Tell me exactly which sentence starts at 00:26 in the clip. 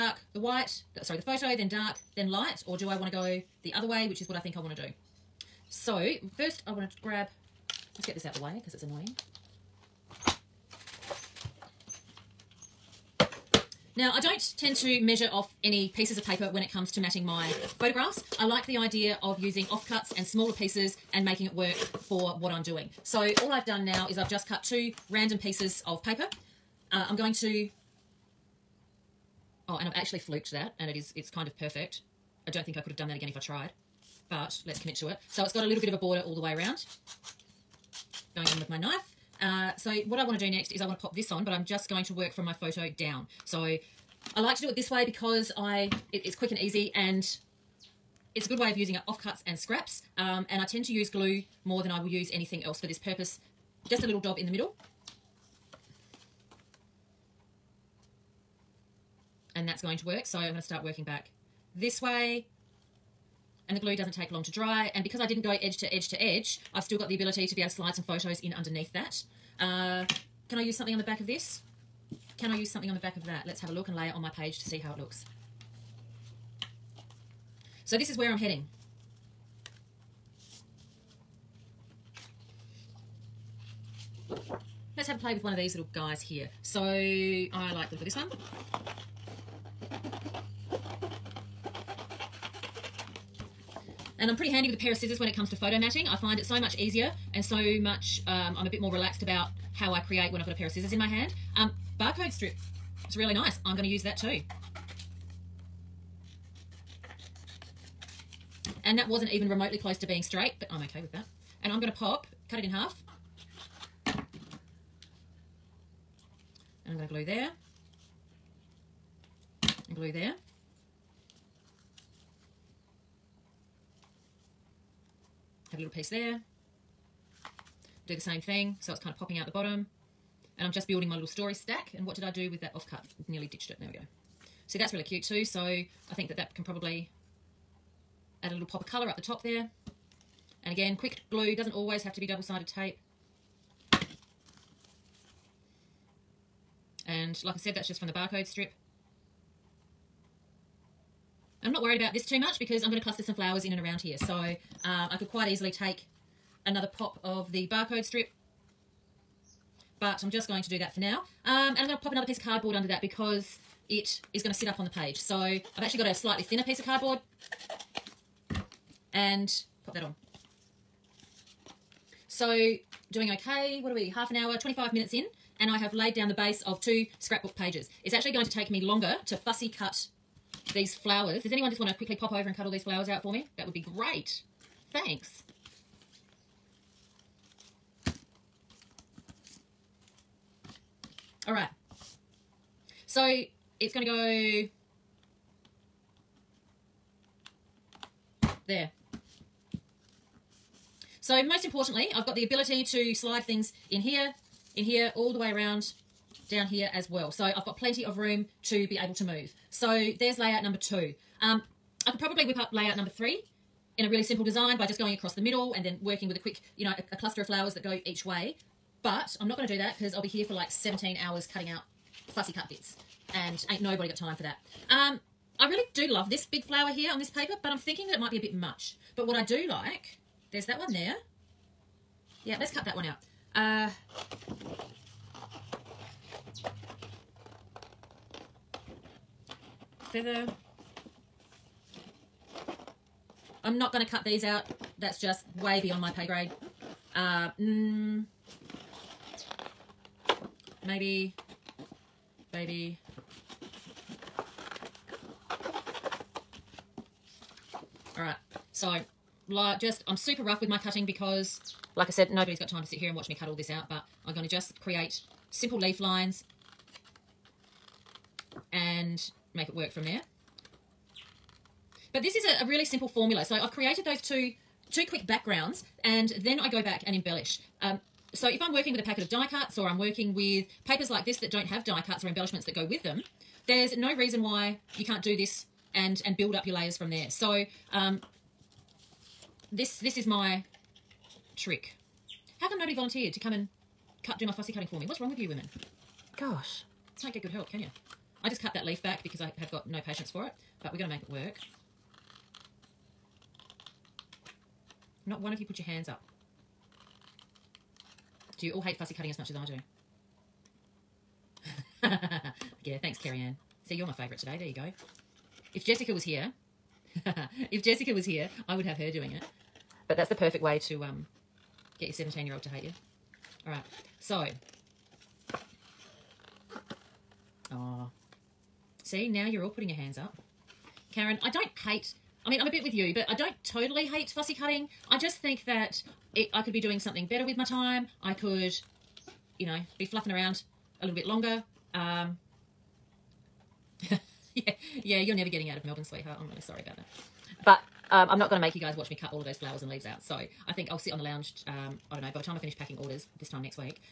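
Uh, I'm going to, oh, and I've actually fluked that and it is, it's kind of perfect.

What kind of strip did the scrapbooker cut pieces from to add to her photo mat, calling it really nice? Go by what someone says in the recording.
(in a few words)
Barcode strips.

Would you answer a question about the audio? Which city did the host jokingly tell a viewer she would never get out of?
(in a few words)
Melbourne.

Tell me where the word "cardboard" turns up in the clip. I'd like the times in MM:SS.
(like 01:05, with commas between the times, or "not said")
02:42, 02:46.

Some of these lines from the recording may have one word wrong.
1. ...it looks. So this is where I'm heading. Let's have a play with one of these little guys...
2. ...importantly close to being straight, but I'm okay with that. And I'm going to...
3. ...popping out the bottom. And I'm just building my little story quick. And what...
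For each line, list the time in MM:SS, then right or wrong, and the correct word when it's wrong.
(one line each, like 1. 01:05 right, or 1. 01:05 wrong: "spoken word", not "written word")
1. 01:14 right
2. 01:49 wrong: "remotely", not "importantly"
3. 02:09 wrong: "stack", not "quick".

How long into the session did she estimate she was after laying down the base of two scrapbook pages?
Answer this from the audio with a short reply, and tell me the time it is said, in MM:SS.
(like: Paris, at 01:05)
25 minutes, at 02:54.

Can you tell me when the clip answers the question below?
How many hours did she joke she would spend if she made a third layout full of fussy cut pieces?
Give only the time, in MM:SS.
03:40.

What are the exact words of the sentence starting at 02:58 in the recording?
It's actually going to take me longer to fussy cut these flowers.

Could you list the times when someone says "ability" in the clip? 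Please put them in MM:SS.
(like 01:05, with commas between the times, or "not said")
01:07, 03:22.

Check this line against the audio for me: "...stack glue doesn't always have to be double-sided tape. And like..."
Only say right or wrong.
wrong.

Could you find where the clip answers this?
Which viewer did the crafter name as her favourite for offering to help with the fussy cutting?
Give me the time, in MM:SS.
05:13.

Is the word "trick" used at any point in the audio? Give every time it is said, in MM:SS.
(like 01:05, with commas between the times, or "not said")
04:51.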